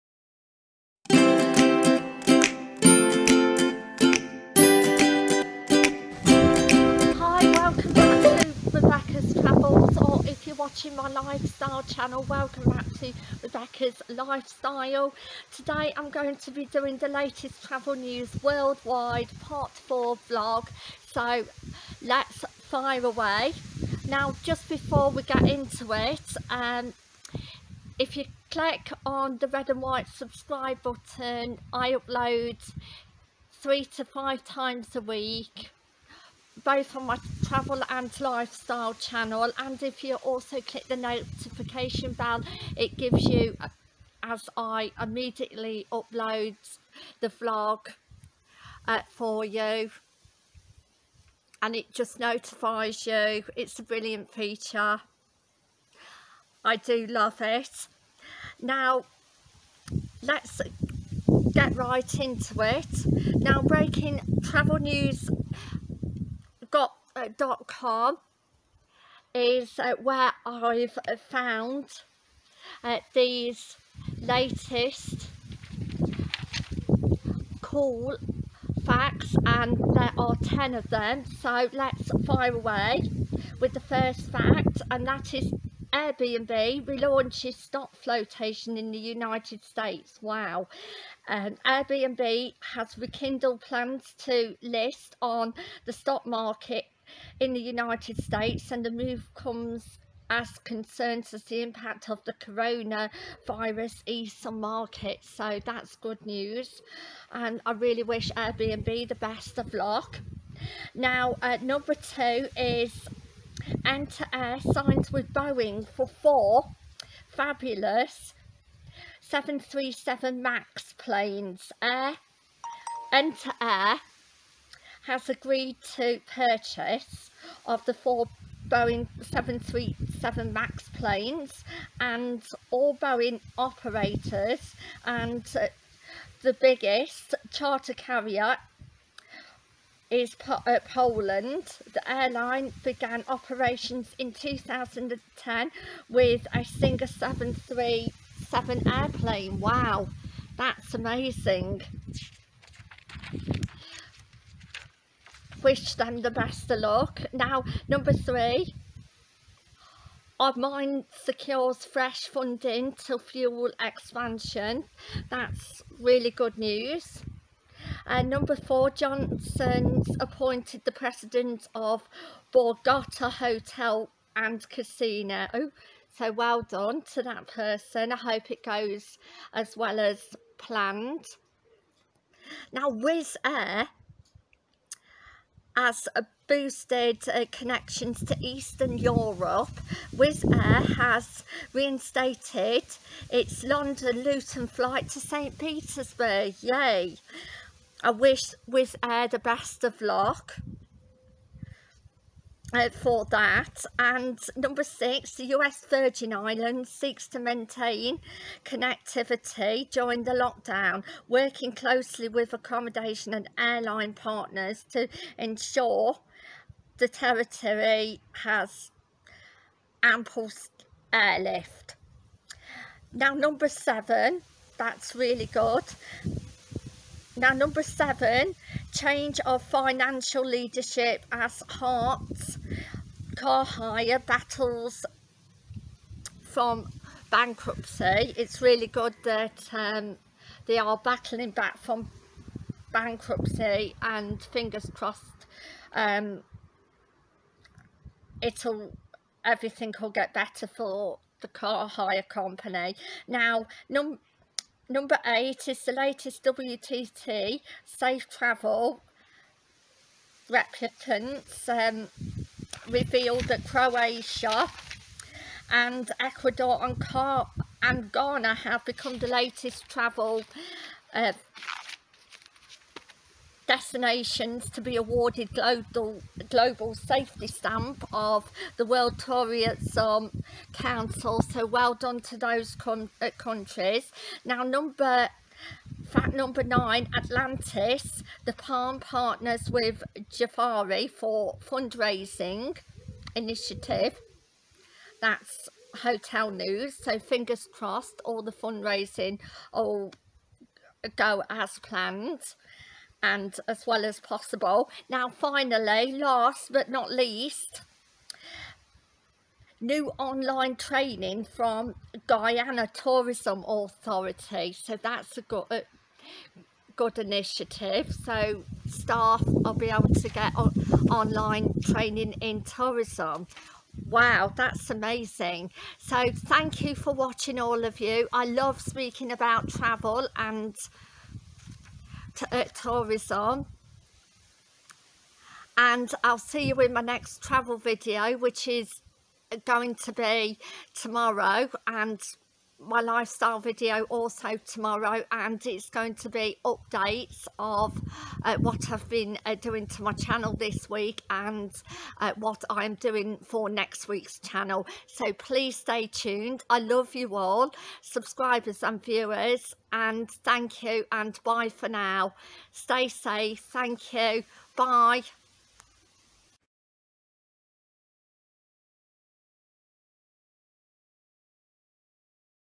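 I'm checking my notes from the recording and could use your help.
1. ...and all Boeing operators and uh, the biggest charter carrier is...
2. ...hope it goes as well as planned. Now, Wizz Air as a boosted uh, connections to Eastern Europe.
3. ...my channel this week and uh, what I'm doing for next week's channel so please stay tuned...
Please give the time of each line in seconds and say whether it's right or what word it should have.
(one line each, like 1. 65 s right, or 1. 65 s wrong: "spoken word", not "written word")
1. 131 s right
2. 178 s right
3. 350 s right.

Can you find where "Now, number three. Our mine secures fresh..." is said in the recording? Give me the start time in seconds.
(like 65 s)
157 s.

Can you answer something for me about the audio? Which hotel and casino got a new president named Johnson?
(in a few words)
Borgata Hotel and Casino.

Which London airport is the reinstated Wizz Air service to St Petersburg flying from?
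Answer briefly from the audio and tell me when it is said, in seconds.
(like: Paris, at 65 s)
Luton, at 194 s.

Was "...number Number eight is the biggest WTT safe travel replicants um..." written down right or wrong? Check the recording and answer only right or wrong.
wrong.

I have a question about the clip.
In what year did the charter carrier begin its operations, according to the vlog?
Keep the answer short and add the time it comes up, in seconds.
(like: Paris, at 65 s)
2010, at 144 s.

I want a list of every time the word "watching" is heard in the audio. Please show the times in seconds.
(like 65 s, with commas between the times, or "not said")
10 s, 327 s.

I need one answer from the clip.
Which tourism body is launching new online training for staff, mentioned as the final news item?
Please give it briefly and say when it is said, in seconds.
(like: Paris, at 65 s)
Guyana Tourism Authority, at 312 s.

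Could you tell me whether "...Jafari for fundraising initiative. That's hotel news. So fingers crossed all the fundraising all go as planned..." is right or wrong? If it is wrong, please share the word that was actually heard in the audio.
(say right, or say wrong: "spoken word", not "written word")
right.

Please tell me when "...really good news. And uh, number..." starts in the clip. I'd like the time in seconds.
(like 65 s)
165 s.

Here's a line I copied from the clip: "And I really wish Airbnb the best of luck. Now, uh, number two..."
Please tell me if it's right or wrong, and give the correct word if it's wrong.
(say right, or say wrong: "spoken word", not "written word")
right.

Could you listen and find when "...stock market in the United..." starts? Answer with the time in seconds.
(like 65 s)
95 s.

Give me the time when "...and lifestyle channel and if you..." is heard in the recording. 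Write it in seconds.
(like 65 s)
37 s.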